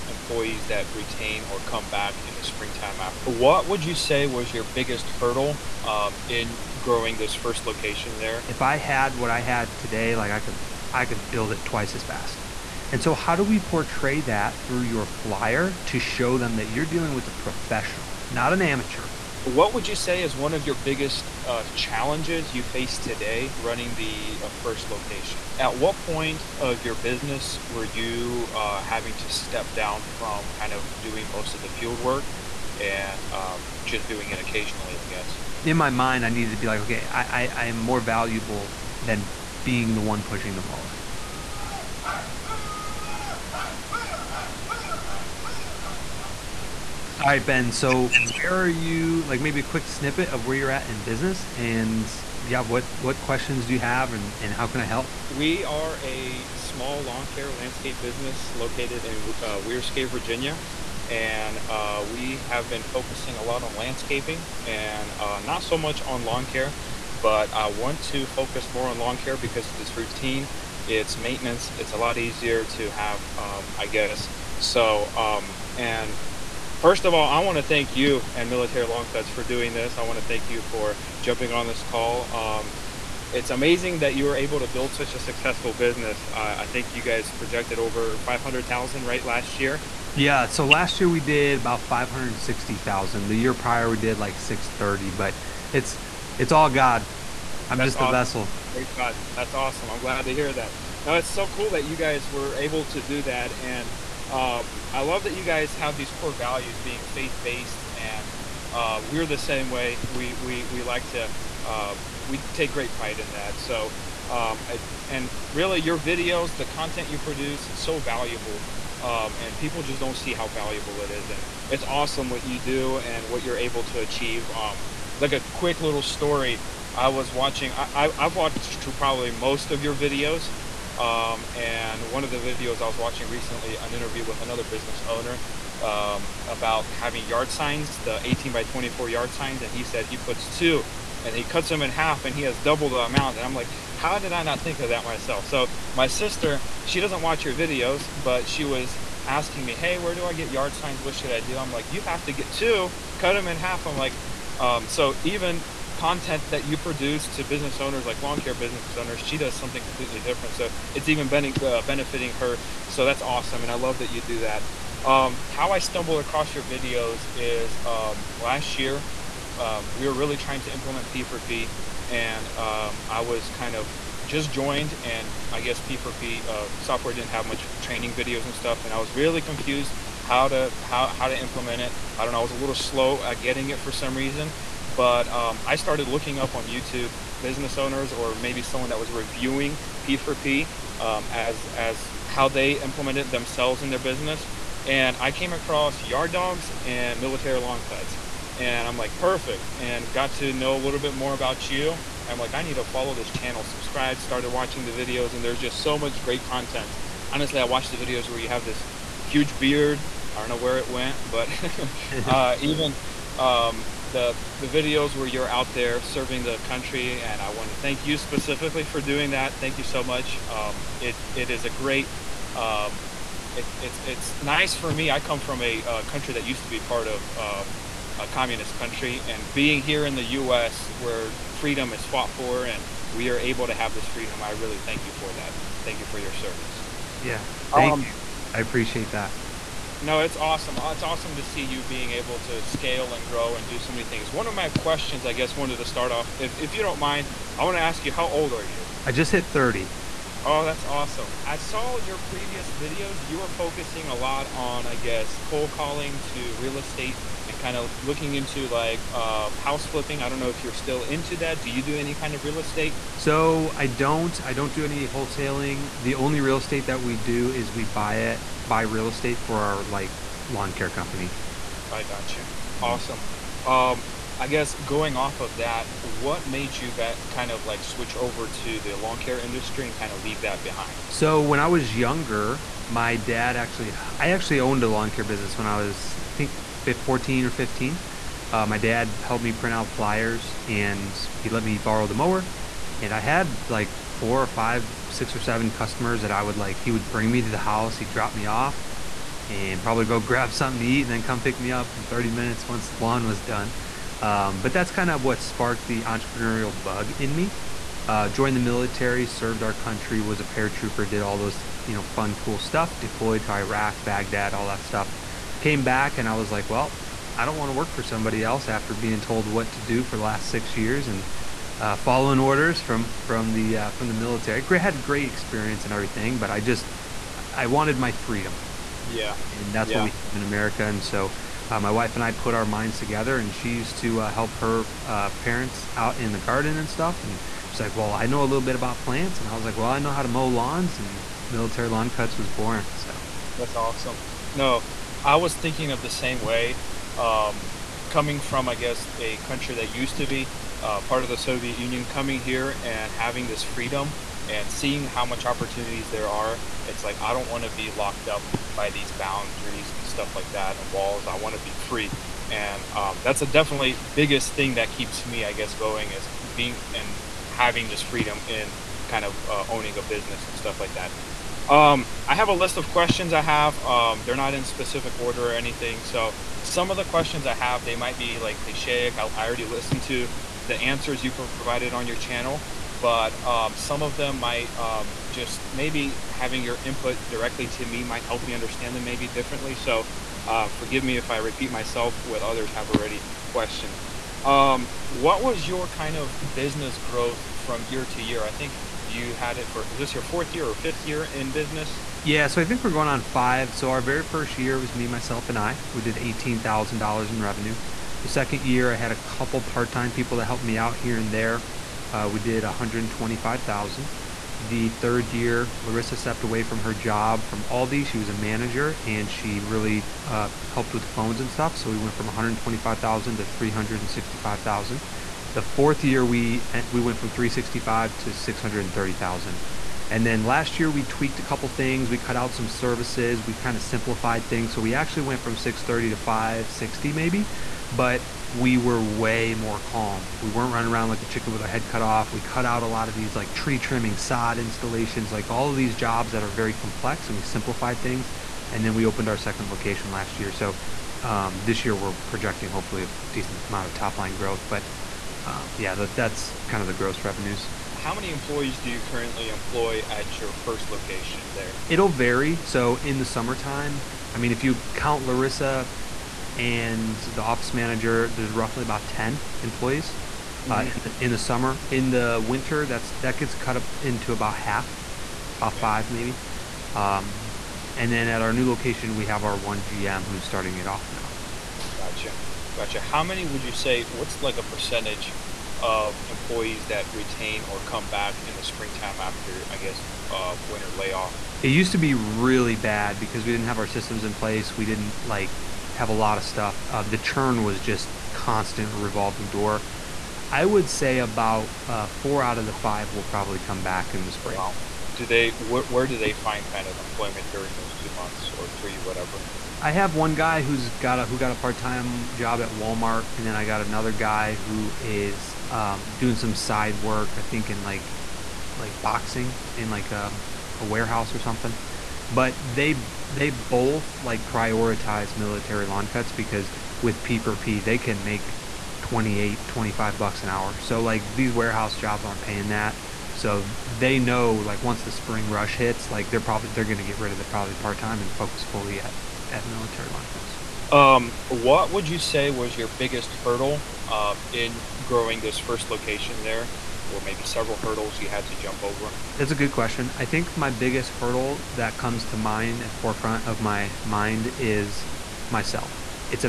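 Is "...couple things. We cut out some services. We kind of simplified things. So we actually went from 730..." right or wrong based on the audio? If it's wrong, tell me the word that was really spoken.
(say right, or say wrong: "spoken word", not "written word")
wrong: "630", not "730".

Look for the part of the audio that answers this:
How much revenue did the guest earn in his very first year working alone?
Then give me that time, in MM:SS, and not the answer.
06:46.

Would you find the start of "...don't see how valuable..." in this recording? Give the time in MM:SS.
02:00.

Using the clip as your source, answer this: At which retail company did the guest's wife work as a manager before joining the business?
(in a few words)
Aldi.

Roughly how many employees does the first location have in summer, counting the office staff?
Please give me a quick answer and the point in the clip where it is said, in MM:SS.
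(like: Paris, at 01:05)
10, at 07:49.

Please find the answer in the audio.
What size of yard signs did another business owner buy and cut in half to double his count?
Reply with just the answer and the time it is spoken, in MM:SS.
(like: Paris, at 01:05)
18 by 24, at 02:18.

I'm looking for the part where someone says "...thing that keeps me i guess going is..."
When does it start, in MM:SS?
06:04.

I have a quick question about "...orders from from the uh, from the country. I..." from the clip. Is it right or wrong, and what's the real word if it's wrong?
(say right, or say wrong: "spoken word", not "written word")
wrong: "military", not "country".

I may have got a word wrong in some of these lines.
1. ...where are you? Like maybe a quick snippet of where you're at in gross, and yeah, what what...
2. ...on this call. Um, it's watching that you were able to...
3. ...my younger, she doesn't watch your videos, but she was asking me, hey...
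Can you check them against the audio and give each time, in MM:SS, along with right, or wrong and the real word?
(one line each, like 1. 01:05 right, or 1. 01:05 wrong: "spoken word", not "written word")
1. 00:48 wrong: "business", not "gross"
2. 01:21 wrong: "amazing", not "watching"
3. 02:25 wrong: "sister", not "younger".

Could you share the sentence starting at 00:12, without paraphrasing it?
And so how do we portray that through your flyer to show them that you're dealing with a professional, not an amateur?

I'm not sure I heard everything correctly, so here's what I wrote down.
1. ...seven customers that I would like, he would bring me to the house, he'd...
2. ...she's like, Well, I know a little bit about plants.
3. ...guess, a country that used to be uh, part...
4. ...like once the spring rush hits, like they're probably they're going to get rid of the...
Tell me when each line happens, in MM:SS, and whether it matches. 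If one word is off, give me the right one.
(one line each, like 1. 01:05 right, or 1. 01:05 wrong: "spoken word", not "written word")
1. 04:55 right
2. 05:37 right
3. 05:48 right
4. 08:54 right.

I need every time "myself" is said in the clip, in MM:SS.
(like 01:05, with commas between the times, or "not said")
02:25, 06:31, 06:45, 09:15.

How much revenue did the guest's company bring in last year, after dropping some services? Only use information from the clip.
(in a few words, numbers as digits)
560,000.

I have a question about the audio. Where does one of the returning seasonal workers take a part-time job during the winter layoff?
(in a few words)
Walmart.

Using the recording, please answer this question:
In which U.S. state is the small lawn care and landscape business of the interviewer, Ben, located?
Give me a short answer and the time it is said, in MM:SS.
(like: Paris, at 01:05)
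Virginia, at 01:00.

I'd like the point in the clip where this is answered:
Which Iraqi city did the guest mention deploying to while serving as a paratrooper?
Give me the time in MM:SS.
05:14.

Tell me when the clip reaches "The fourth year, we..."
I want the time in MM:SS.
07:05.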